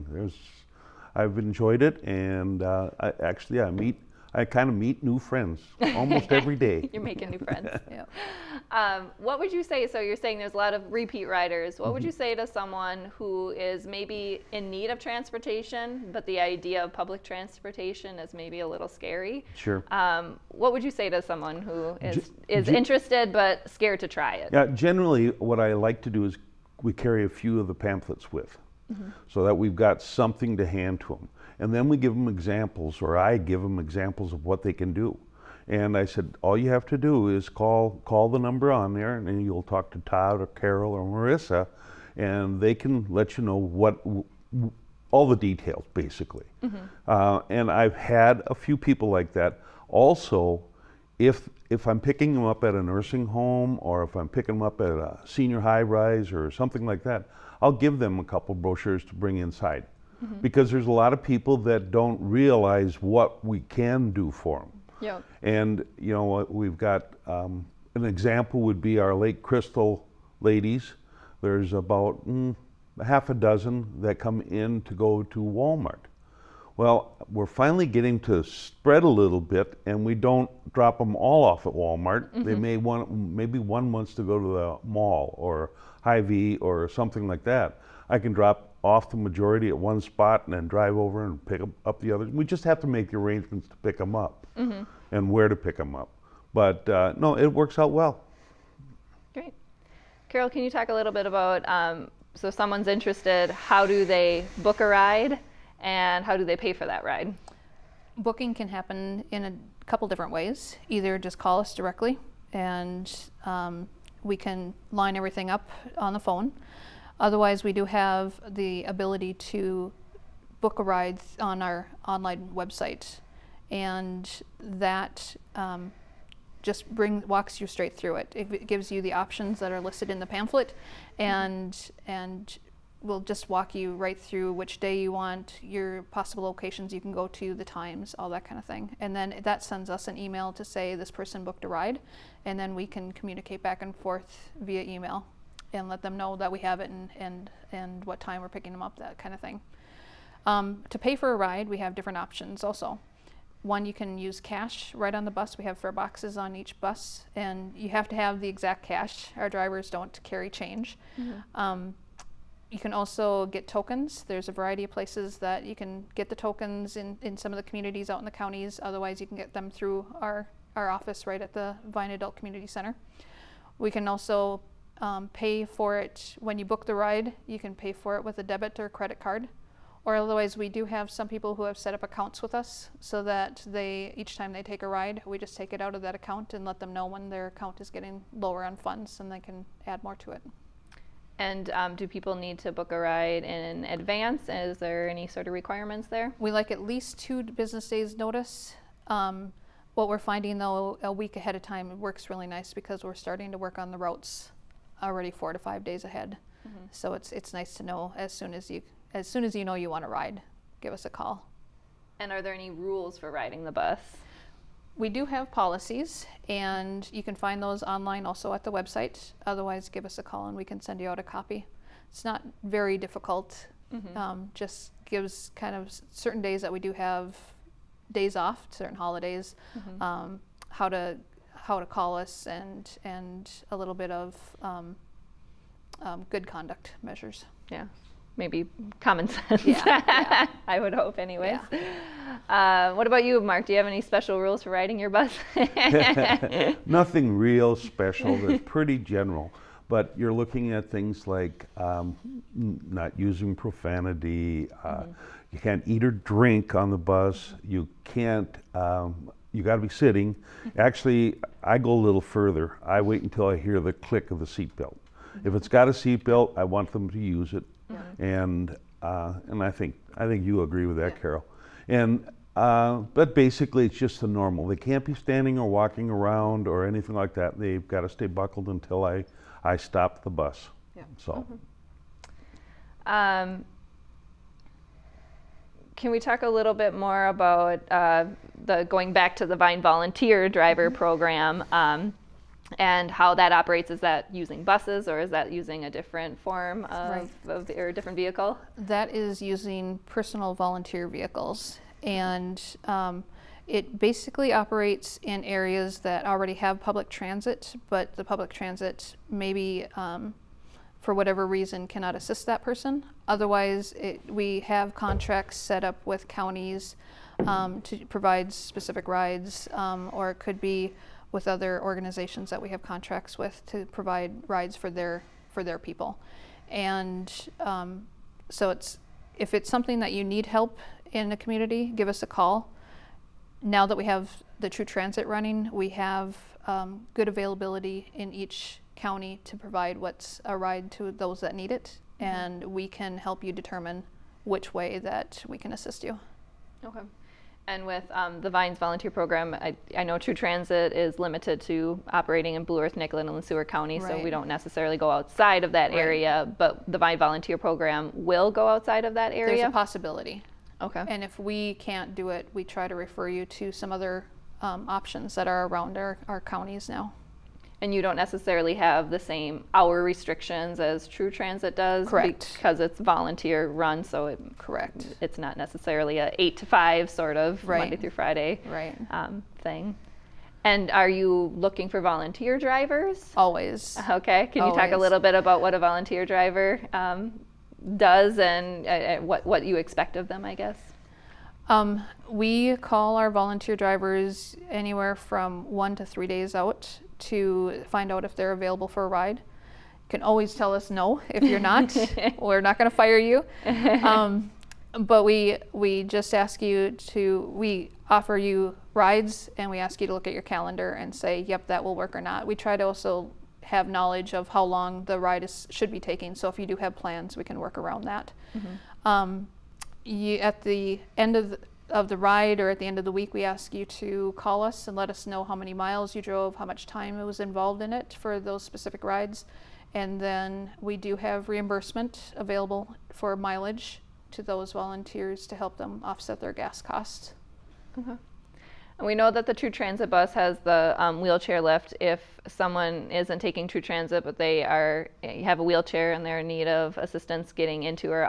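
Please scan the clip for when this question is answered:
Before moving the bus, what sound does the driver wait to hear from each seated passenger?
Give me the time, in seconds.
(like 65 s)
263 s.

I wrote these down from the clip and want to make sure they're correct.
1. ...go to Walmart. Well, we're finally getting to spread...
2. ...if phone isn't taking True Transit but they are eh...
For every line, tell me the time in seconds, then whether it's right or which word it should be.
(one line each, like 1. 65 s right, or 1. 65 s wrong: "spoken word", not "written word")
1. 74 s right
2. 442 s wrong: "someone", not "phone".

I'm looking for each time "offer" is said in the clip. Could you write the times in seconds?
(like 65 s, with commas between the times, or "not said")
408 s.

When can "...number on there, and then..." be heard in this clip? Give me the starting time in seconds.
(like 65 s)
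38 s.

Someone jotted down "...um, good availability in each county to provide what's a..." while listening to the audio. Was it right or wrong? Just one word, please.
right.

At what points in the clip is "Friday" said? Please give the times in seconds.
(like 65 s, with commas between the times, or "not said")
378 s.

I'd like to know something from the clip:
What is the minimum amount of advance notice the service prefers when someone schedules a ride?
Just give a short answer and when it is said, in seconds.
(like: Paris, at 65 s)
2 business days, at 197 s.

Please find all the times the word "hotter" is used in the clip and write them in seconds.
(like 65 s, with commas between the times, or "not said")
not said.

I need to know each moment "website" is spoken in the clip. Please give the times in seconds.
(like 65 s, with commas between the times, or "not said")
122 s, 218 s.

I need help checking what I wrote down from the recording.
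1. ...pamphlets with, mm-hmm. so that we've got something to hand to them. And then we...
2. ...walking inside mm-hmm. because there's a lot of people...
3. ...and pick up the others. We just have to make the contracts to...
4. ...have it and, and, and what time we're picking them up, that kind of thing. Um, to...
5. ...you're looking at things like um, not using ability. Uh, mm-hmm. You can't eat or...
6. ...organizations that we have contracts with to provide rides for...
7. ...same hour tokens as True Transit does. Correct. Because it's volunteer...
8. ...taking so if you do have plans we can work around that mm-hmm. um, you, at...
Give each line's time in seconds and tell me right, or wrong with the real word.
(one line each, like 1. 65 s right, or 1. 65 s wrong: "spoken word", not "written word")
1. 27 s right
2. 59 s wrong: "bring", not "walking"
3. 91 s wrong: "arrangements", not "contracts"
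4. 146 s right
5. 250 s wrong: "profanity", not "ability"
6. 321 s right
7. 369 s wrong: "restrictions", not "tokens"
8. 416 s right.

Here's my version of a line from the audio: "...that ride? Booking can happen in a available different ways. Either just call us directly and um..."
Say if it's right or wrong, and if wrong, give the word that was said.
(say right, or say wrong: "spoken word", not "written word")
wrong: "couple", not "available".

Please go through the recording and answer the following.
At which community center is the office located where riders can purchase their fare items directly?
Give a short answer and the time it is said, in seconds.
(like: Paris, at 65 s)
Vine Adult Community Center, at 171 s.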